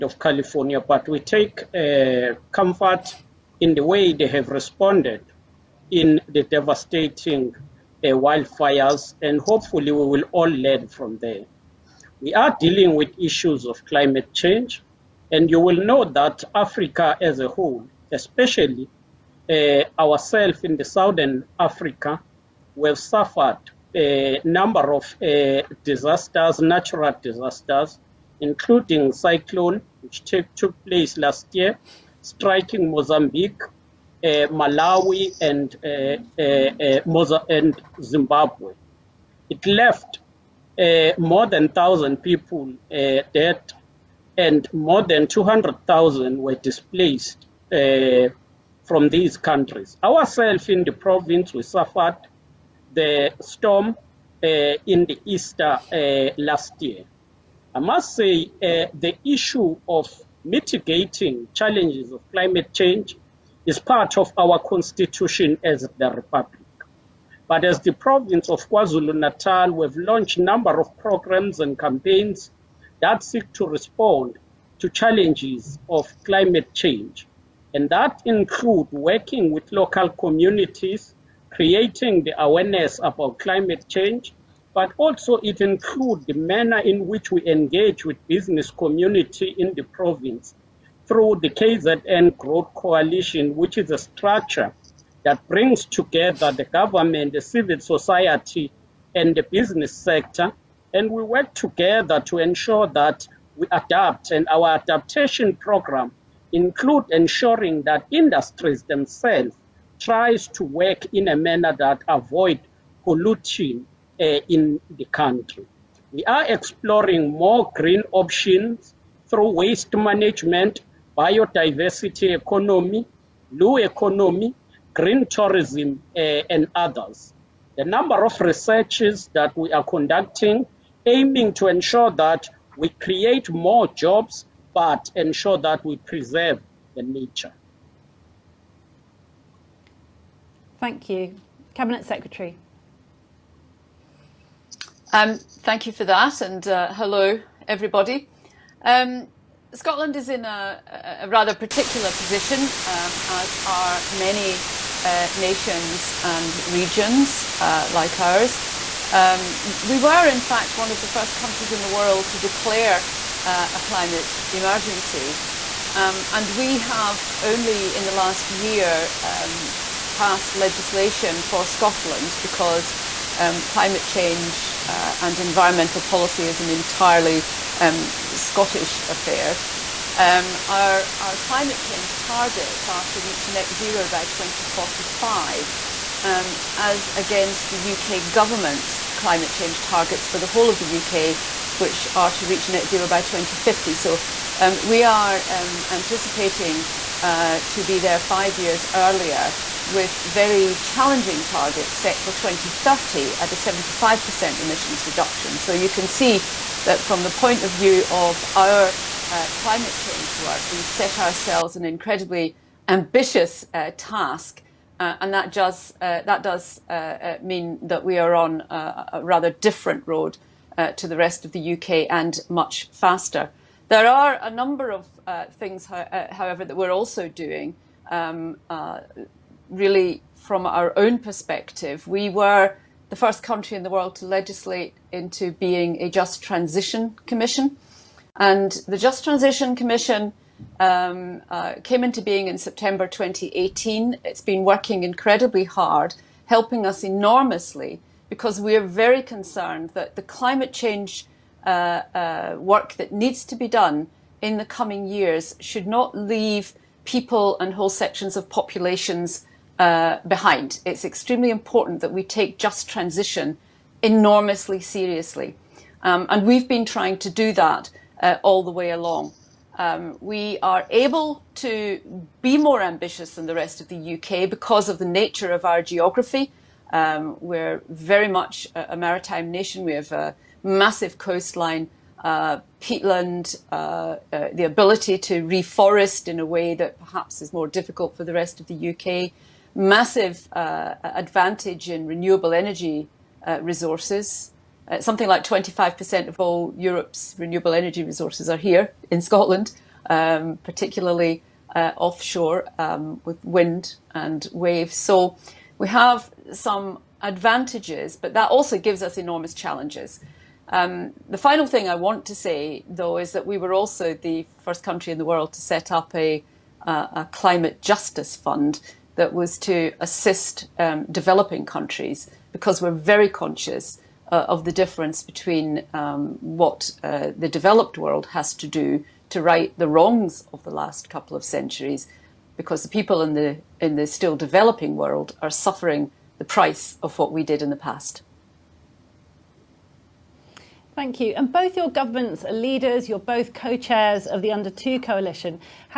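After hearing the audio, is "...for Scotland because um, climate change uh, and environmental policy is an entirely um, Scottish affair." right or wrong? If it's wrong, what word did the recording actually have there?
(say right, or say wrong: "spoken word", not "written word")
right.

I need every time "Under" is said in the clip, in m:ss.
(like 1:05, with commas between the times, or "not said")
5:44.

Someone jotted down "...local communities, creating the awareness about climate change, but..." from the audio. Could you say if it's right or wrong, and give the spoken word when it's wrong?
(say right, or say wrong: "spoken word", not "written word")
right.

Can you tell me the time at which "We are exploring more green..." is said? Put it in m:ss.
1:56.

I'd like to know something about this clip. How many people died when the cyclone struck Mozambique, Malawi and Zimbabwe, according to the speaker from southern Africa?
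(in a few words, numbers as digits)
more than 1,000.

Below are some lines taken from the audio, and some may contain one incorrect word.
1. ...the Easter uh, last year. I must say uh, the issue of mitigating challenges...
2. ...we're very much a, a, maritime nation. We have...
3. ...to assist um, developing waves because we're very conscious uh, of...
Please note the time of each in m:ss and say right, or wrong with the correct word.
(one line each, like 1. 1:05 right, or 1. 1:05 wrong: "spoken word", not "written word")
1. 0:55 right
2. 4:37 right
3. 5:19 wrong: "countries", not "waves".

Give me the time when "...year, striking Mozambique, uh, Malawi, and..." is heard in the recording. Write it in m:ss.
0:31.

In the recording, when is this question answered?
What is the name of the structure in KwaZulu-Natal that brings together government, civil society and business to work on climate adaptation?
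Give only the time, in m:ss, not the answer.
1:31.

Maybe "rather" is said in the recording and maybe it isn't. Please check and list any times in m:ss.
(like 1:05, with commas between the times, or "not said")
2:31, 3:39.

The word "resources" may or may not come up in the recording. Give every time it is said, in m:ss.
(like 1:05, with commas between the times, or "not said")
4:53, 4:58.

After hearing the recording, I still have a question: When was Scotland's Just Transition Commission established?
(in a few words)
September 2018.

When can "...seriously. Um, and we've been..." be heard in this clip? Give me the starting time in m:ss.
4:24.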